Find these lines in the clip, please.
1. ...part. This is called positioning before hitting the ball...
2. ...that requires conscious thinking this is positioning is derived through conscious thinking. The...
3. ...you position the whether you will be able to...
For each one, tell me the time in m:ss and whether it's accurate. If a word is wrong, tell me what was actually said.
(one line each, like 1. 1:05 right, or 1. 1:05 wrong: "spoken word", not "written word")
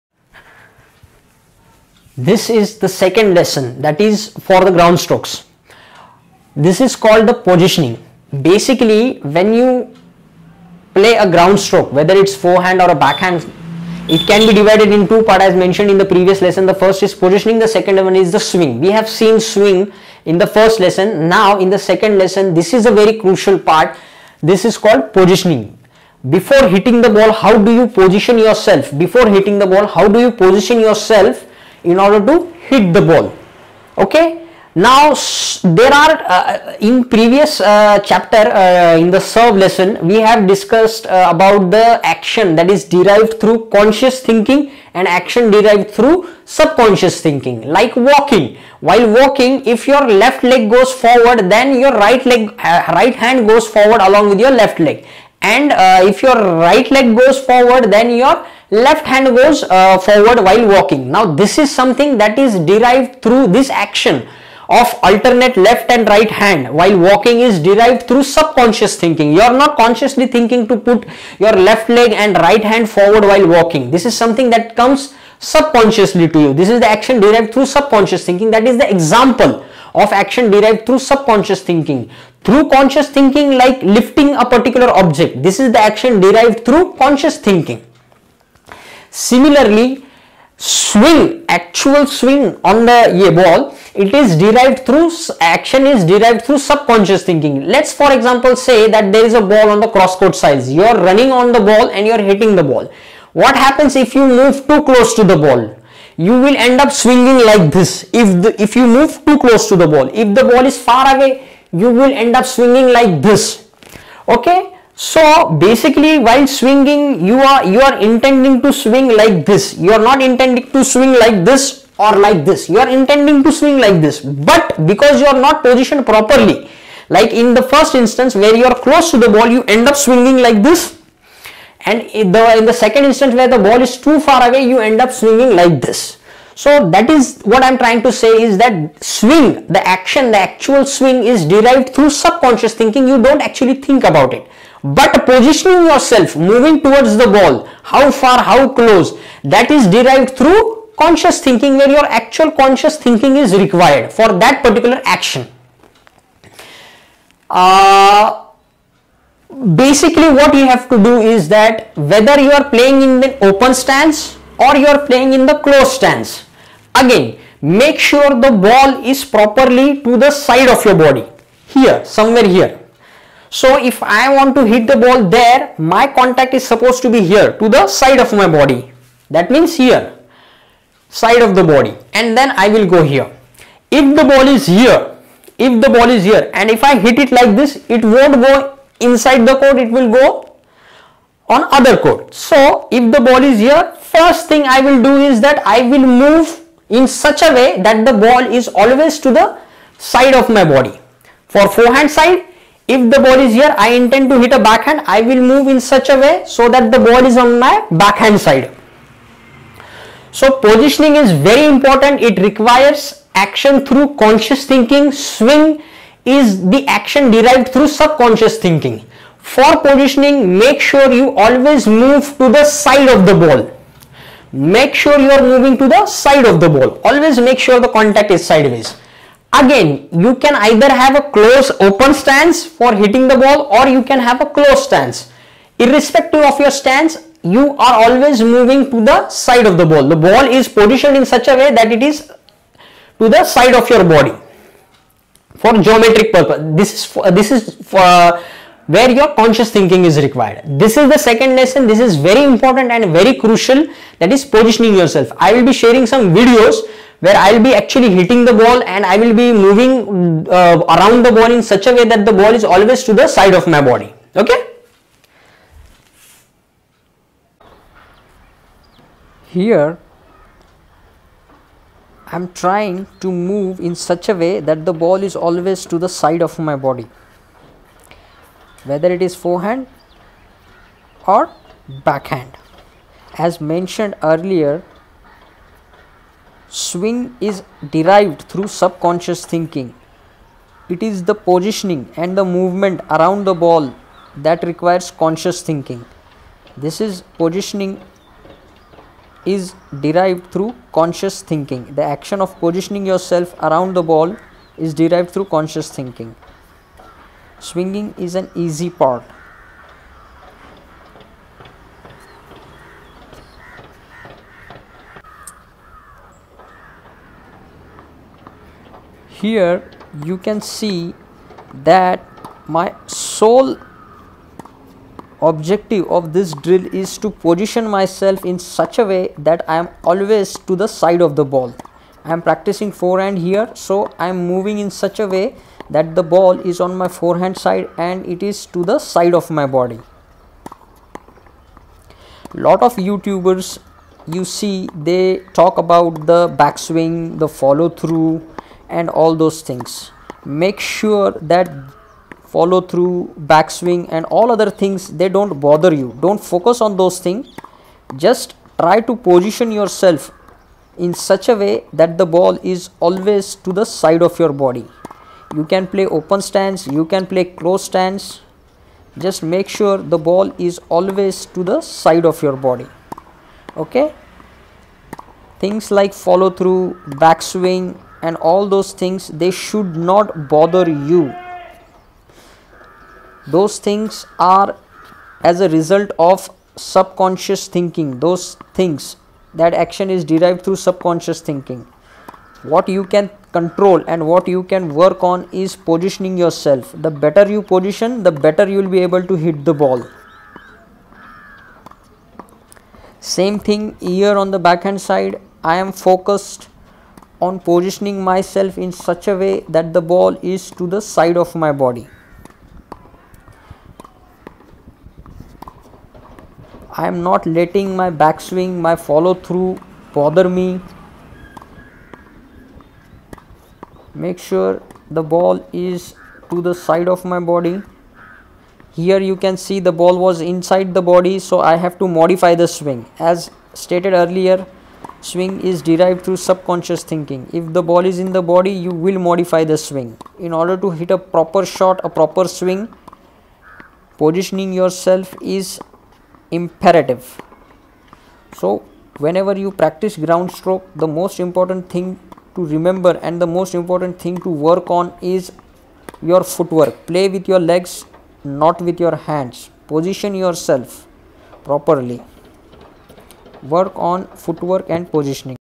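1. 0:23 right
2. 4:54 right
3. 6:37 wrong: "better", not "whether".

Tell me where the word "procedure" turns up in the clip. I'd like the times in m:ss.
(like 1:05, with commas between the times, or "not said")
not said.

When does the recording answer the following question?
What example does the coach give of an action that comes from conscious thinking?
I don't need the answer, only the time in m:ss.
1:23.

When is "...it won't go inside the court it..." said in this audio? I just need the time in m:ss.
3:07.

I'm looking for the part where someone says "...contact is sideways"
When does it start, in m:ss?
3:47.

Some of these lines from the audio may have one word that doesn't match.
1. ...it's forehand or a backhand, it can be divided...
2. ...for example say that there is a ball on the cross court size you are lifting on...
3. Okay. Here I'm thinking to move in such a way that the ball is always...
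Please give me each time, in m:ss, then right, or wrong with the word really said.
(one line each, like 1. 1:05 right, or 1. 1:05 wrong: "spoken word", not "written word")
1. 0:12 right
2. 1:37 wrong: "running", not "lifting"
3. 4:24 wrong: "trying", not "thinking".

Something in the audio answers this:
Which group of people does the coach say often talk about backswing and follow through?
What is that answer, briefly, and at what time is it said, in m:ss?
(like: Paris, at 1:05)
YouTubers, at 5:42.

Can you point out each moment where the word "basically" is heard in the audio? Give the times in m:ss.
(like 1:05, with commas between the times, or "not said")
0:08, 1:55, 2:39.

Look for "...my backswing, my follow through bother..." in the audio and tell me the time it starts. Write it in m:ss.
6:57.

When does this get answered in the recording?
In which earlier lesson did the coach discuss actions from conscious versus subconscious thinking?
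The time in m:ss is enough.
0:39.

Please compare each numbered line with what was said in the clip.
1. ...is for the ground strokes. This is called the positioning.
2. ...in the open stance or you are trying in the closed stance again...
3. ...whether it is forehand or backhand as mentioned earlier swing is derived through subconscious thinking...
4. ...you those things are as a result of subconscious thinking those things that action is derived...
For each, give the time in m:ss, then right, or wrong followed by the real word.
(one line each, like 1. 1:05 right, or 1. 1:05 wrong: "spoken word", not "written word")
1. 0:04 right
2. 2:43 wrong: "playing", not "trying"
3. 4:38 right
4. 6:21 right.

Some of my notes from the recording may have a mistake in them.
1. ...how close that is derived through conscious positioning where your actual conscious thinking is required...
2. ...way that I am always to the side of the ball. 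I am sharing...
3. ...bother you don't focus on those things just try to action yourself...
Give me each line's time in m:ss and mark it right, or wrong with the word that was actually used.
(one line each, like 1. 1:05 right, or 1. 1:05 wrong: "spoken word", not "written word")
1. 2:28 wrong: "thinking", not "positioning"
2. 5:29 wrong: "practicing", not "sharing"
3. 5:55 wrong: "position", not "action".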